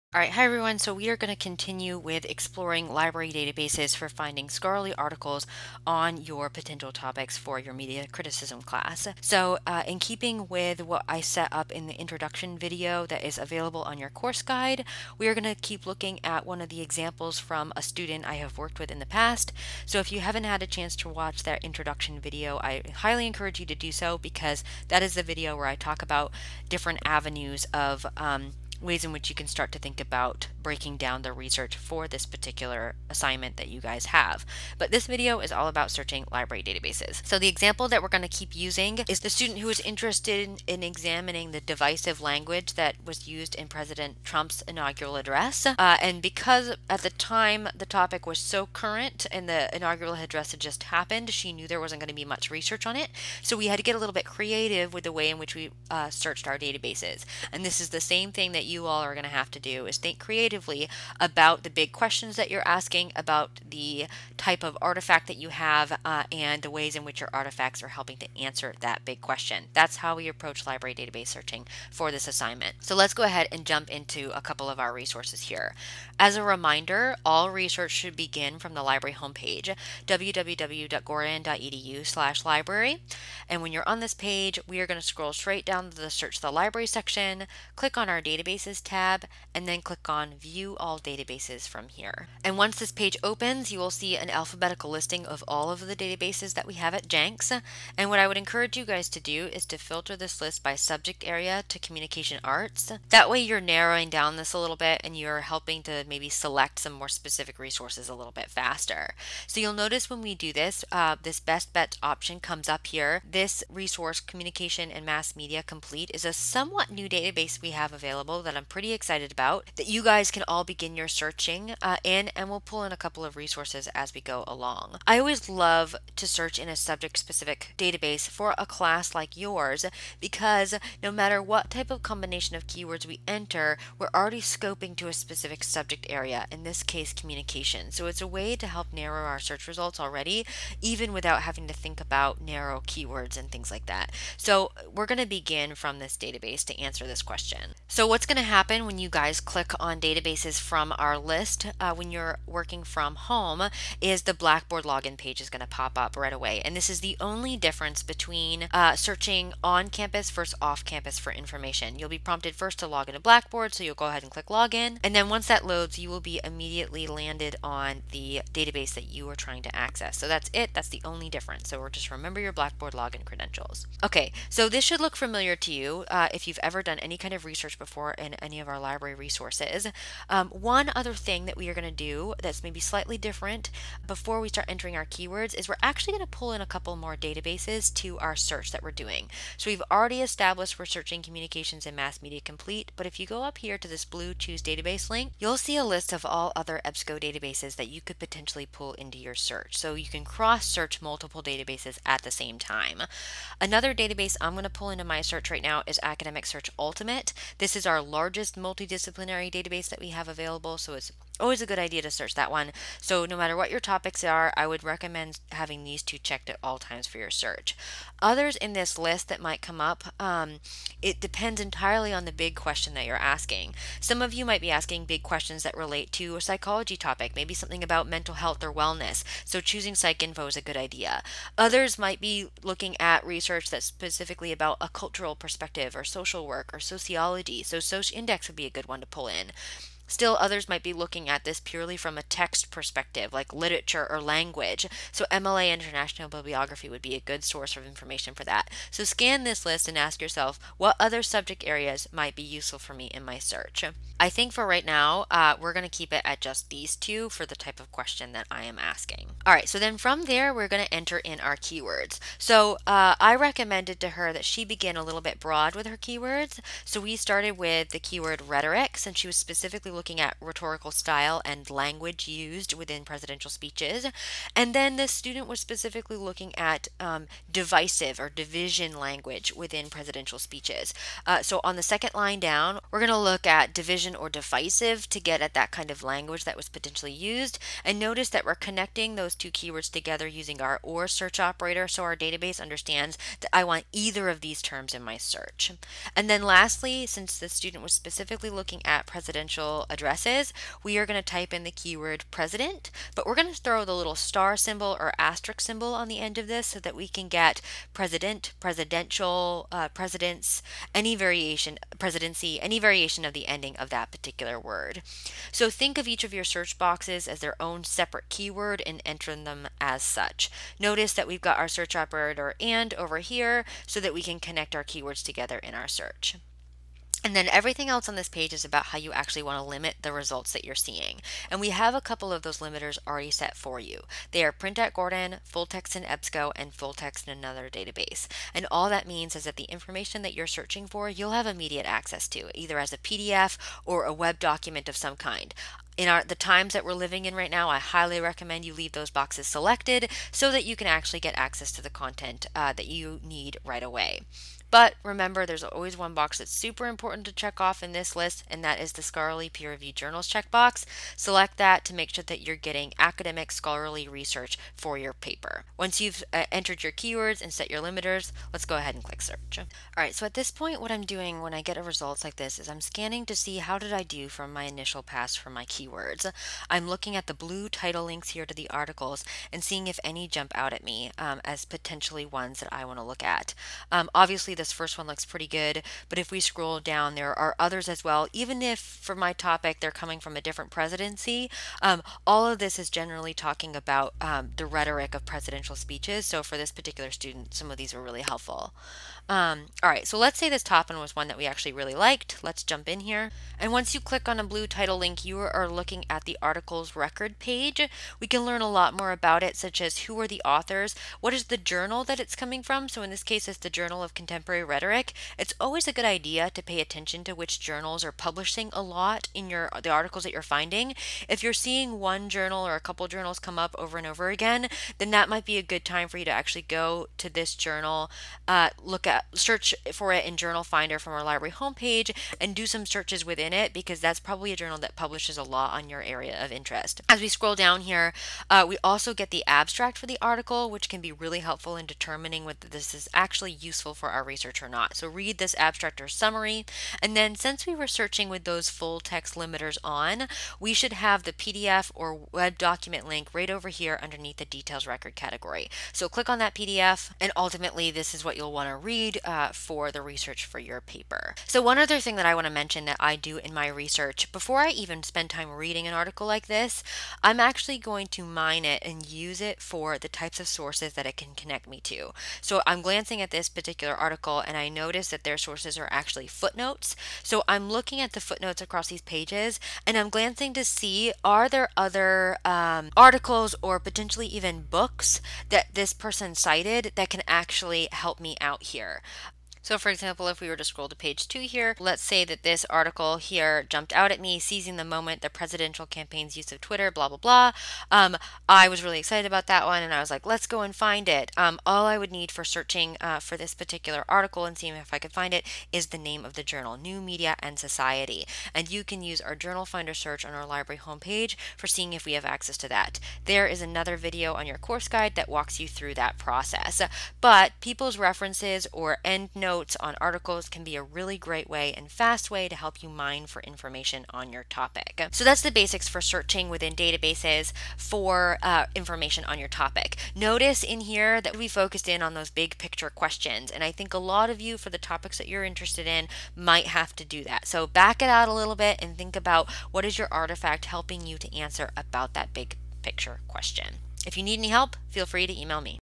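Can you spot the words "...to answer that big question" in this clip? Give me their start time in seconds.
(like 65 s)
68 s.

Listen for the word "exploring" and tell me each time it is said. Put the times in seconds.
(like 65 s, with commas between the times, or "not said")
2 s.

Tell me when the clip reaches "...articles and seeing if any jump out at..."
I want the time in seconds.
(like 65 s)
378 s.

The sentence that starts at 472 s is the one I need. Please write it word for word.
So I'm glancing at this particular article article and I notice that their sources are actually footnotes.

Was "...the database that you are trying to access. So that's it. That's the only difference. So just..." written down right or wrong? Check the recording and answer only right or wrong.
right.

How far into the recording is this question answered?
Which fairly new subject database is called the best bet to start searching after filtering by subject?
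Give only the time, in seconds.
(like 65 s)
114 s.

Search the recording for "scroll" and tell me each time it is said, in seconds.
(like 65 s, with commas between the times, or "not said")
85 s, 386 s, 437 s, 490 s.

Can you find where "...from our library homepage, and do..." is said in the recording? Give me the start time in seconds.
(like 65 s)
430 s.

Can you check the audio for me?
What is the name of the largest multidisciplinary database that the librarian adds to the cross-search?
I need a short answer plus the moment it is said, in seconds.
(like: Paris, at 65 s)
Academic Search Ultimate, at 206 s.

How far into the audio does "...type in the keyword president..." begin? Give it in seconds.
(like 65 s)
301 s.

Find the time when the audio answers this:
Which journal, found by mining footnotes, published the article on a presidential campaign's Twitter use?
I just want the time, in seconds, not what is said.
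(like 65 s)
506 s.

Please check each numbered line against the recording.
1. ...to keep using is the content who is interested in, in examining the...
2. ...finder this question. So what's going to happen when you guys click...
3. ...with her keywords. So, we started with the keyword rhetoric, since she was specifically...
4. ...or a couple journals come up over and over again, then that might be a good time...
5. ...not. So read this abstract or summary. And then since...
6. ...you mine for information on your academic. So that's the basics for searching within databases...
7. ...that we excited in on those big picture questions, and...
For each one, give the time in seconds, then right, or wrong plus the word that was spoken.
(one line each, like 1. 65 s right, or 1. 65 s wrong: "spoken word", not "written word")
1. 38 s wrong: "student", not "content"
2. 146 s wrong: "answer", not "finder"
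3. 265 s right
4. 422 s right
5. 444 s right
6. 522 s wrong: "topic", not "academic"
7. 531 s wrong: "focused", not "excited".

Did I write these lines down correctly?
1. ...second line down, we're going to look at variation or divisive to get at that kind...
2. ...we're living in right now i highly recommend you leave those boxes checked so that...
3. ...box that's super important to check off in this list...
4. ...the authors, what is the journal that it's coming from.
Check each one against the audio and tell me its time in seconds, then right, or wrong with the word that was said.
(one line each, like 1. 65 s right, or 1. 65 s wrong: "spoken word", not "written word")
1. 281 s wrong: "division", not "variation"
2. 346 s wrong: "selected", not "checked"
3. 356 s right
4. 410 s right.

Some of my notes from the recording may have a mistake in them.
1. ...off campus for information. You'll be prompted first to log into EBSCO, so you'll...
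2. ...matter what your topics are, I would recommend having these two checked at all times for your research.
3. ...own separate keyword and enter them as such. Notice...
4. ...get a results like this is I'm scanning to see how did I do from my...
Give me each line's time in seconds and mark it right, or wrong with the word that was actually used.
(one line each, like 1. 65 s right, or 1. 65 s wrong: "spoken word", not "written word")
1. 160 s wrong: "Blackboard", not "EBSCO"
2. 213 s wrong: "search", not "research"
3. 317 s right
4. 371 s right.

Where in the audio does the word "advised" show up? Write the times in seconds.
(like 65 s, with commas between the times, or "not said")
not said.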